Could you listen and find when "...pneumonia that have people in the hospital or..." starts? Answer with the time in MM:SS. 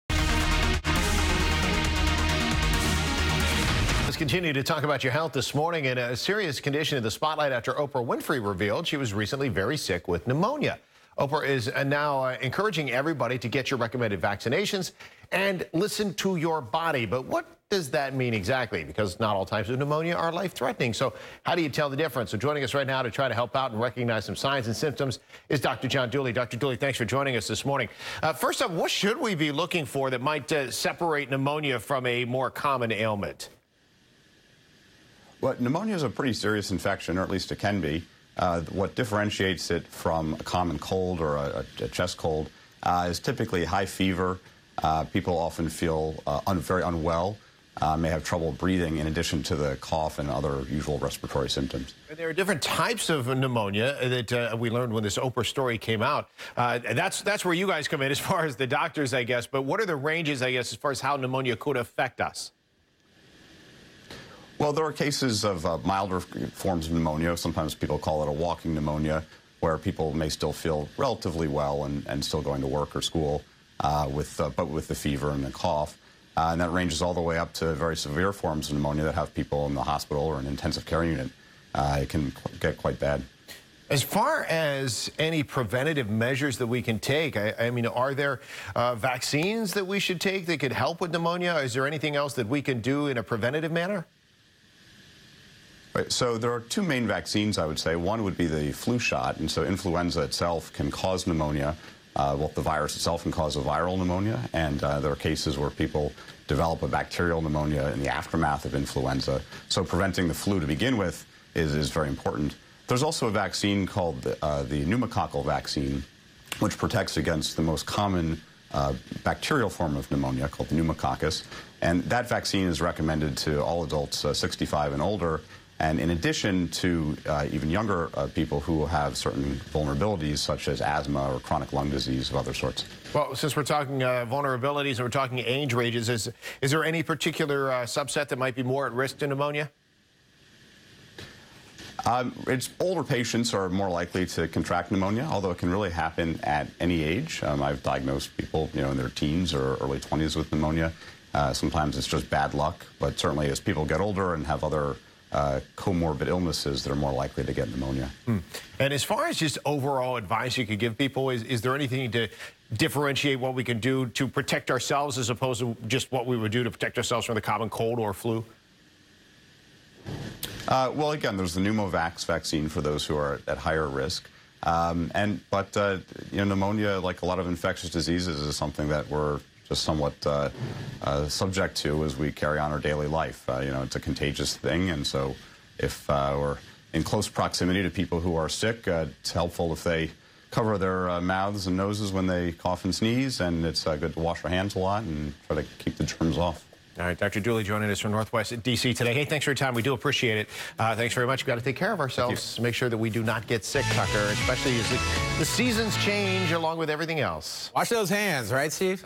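01:18.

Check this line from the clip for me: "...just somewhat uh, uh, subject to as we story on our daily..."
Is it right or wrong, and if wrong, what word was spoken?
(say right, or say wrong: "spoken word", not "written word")
wrong: "carry", not "story".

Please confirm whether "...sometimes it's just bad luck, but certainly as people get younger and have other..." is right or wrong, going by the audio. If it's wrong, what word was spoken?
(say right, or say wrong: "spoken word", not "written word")
wrong: "older", not "younger".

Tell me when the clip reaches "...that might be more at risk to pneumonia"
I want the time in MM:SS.
02:18.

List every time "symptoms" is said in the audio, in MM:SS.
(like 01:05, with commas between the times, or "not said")
00:24, 00:51.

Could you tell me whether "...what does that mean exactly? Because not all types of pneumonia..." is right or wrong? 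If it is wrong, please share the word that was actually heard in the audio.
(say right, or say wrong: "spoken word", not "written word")
right.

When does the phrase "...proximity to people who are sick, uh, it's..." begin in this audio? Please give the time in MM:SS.
03:07.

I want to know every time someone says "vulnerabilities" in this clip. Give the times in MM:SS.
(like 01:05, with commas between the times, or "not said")
02:09, 02:14.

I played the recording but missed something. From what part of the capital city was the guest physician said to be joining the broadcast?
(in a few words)
Northwest D.C.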